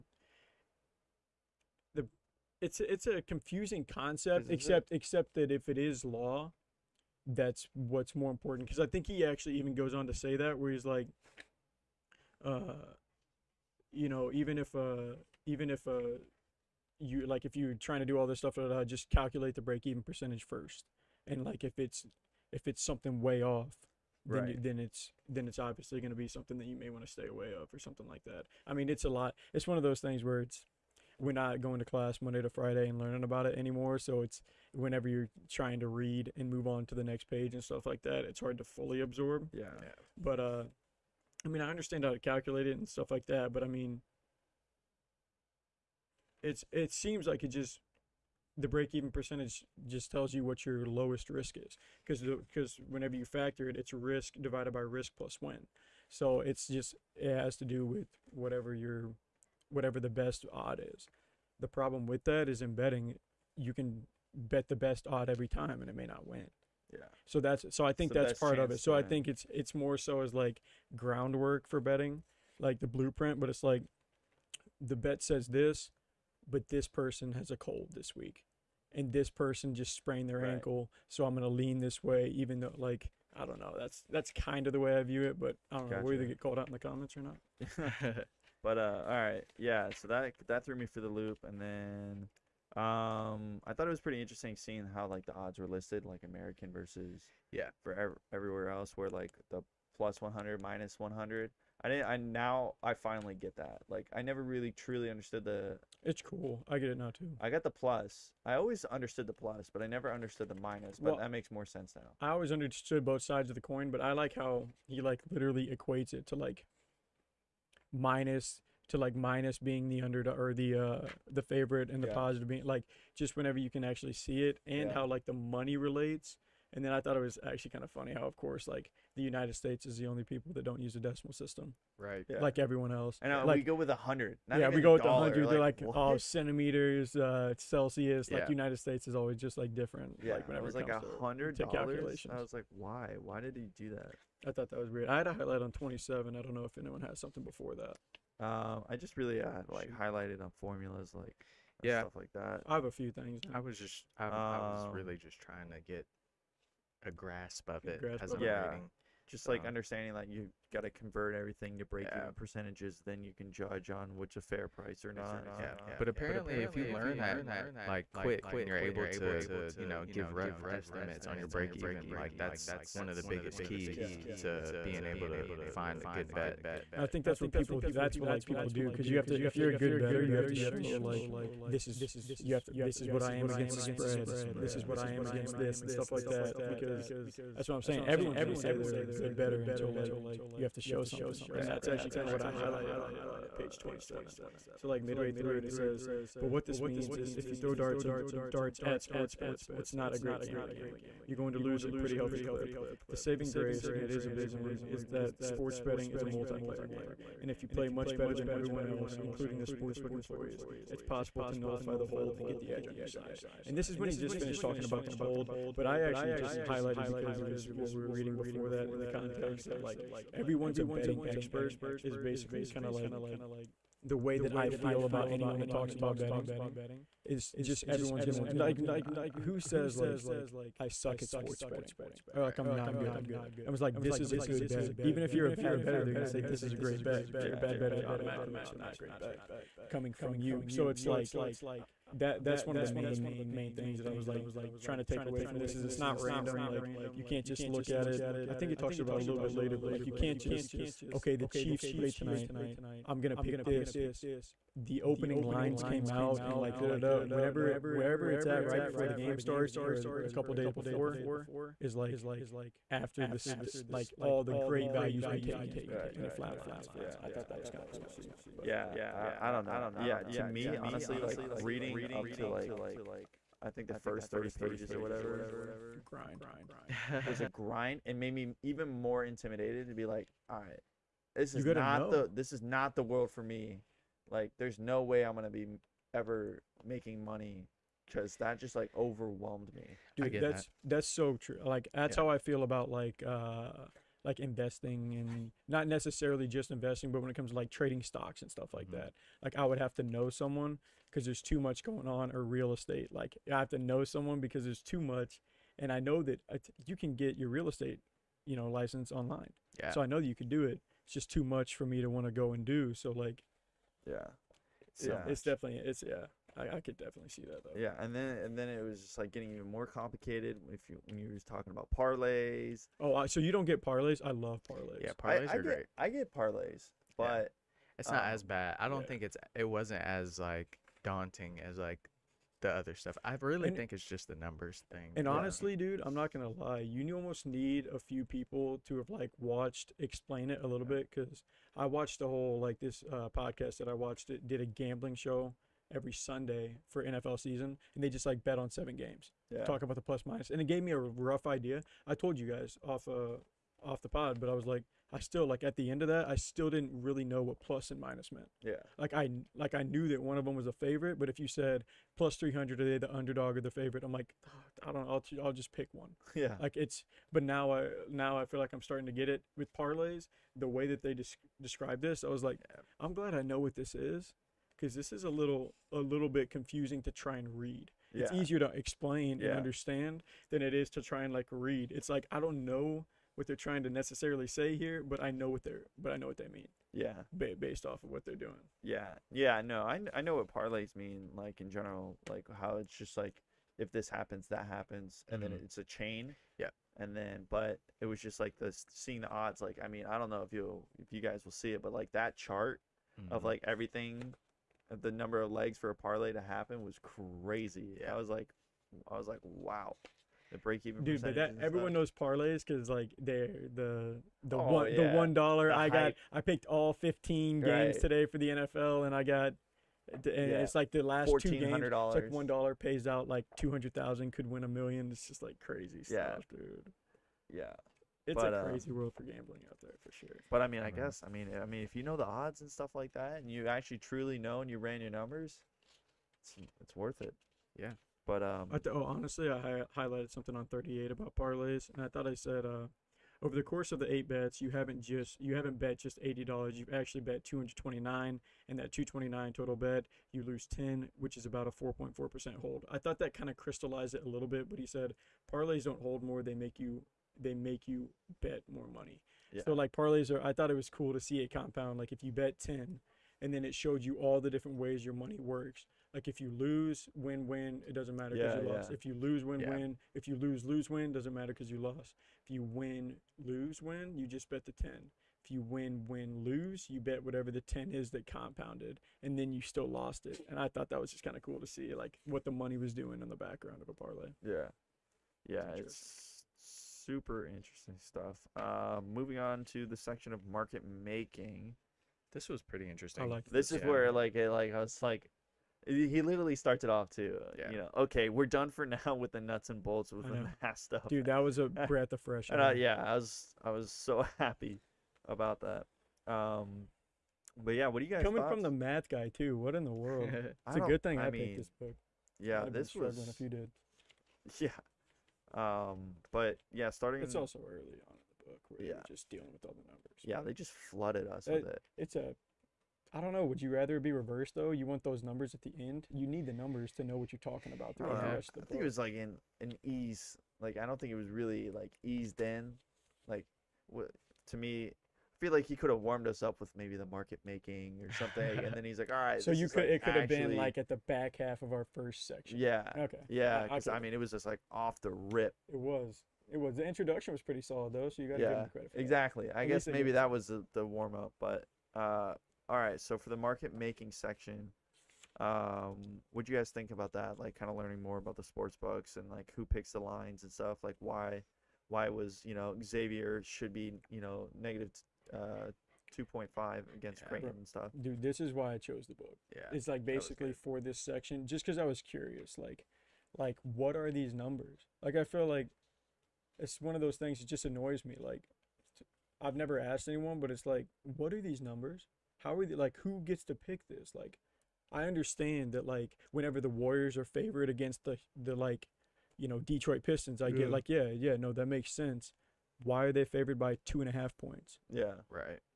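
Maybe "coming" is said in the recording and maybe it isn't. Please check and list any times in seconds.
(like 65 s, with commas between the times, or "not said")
239 s, 508 s.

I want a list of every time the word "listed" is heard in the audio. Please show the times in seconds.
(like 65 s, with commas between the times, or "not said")
95 s.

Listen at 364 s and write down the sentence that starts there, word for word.
I'm like, oh, I don't know.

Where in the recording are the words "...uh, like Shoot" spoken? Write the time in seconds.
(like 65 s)
149 s.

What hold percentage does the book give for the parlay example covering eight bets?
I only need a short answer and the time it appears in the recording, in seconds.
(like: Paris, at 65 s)
4.4 percent, at 451 s.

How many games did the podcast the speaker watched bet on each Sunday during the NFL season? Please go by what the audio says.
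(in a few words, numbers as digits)
7.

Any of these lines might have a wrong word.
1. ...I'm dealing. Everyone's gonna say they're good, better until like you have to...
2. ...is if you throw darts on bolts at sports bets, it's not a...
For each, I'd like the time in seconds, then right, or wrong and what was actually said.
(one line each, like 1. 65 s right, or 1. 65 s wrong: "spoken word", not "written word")
1. 187 s wrong: "saying", not "dealing"
2. 197 s wrong: "darts", not "bolts".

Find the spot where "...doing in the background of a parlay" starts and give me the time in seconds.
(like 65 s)
482 s.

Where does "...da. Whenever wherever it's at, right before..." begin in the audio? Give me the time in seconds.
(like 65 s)
256 s.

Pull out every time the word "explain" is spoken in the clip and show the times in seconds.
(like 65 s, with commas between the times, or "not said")
339 s, 378 s.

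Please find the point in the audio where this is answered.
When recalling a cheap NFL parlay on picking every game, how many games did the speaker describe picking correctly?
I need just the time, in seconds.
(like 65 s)
416 s.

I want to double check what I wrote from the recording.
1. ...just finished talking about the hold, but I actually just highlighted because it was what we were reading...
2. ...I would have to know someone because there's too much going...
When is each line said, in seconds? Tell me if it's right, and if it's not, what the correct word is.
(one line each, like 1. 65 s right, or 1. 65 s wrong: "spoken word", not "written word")
1. 214 s right
2. 299 s right.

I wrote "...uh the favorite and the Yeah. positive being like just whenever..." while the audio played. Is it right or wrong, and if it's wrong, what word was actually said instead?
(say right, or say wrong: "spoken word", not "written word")
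right.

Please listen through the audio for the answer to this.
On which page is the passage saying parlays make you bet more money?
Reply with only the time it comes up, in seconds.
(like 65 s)
440 s.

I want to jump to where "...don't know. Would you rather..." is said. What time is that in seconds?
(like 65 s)
523 s.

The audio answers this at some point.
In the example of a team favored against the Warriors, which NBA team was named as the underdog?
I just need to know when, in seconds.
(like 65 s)
589 s.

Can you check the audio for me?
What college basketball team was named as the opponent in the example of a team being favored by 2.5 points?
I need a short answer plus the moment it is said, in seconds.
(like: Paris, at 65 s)
Creighton, at 567 s.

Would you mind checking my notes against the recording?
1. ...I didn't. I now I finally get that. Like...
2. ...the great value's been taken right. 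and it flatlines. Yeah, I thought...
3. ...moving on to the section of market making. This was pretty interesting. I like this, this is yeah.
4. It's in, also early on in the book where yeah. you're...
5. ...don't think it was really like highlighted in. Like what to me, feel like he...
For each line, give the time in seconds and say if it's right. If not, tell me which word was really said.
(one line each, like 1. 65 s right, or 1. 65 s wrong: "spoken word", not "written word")
1. 101 s right
2. 264 s right
3. 489 s right
4. 517 s right
5. 530 s wrong: "eased", not "highlighted".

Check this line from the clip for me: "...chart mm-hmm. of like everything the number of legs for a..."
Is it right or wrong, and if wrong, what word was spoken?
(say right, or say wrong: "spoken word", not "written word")
right.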